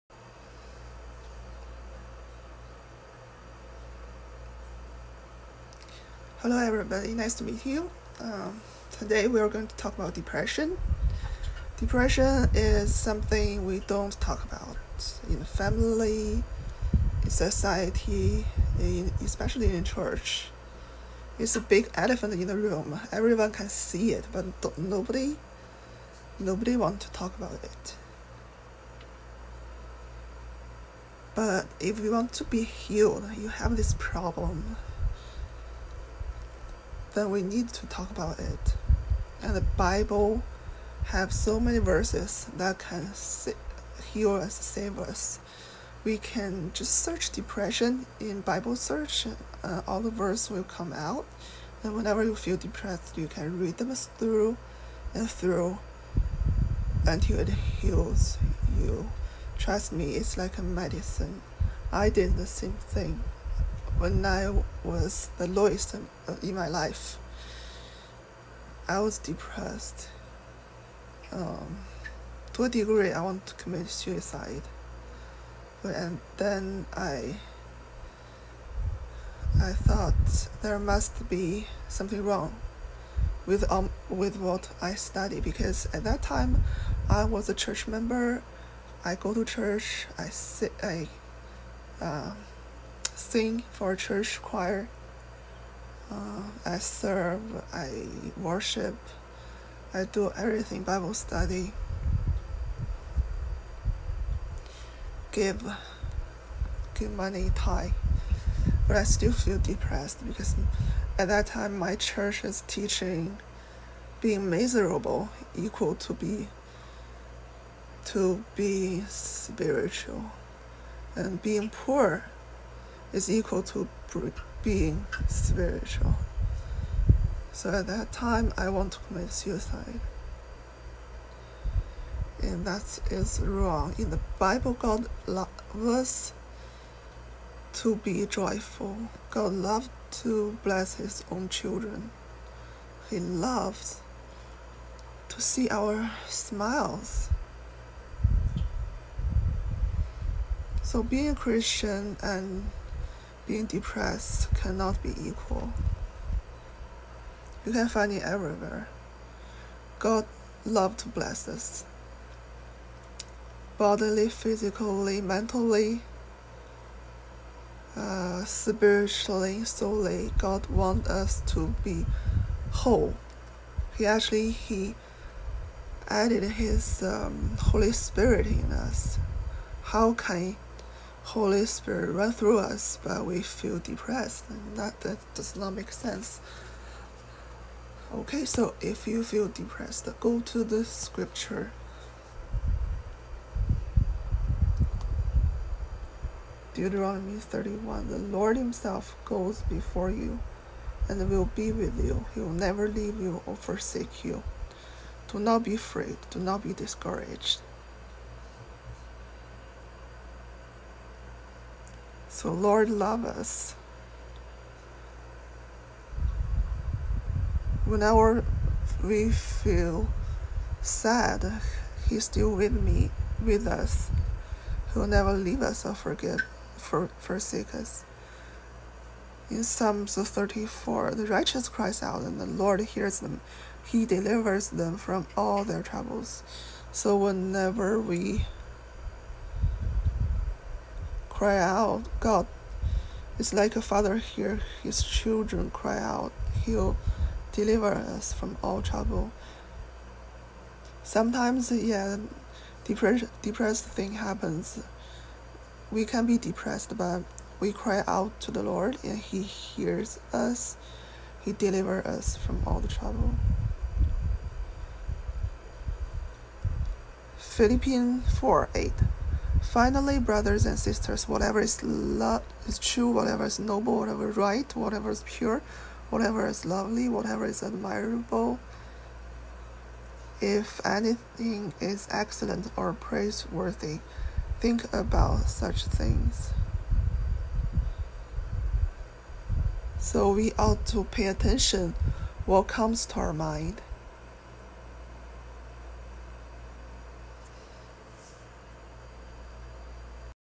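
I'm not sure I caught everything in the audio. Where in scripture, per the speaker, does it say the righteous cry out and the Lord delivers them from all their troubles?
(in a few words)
Psalms 34.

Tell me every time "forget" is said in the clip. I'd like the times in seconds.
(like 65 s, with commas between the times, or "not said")
225 s.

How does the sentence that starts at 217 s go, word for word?
Whenever we feel sad, He's still with me, with us.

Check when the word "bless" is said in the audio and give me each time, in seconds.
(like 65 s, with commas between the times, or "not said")
140 s, 161 s.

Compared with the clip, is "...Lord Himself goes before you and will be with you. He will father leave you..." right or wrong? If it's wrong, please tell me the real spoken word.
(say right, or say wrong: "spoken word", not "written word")
wrong: "never", not "father".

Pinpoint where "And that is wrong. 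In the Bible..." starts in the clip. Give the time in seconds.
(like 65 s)
132 s.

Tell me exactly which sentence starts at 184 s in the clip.
That, that does not make sense.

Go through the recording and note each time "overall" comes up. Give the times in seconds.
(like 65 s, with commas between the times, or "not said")
not said.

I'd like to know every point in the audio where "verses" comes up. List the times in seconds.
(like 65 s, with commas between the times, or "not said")
41 s, 50 s.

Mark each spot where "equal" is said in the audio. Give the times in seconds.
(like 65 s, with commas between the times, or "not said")
115 s, 123 s, 155 s.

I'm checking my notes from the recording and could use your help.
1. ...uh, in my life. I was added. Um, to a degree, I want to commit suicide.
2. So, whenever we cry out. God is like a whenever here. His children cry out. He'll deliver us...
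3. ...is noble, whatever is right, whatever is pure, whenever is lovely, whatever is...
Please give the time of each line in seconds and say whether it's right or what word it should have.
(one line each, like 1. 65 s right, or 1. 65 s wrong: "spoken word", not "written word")
1. 65 s wrong: "depressed", not "added"
2. 236 s wrong: "father", not "whenever"
3. 273 s wrong: "whatever", not "whenever".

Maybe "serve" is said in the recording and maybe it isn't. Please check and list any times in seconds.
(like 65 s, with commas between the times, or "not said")
96 s.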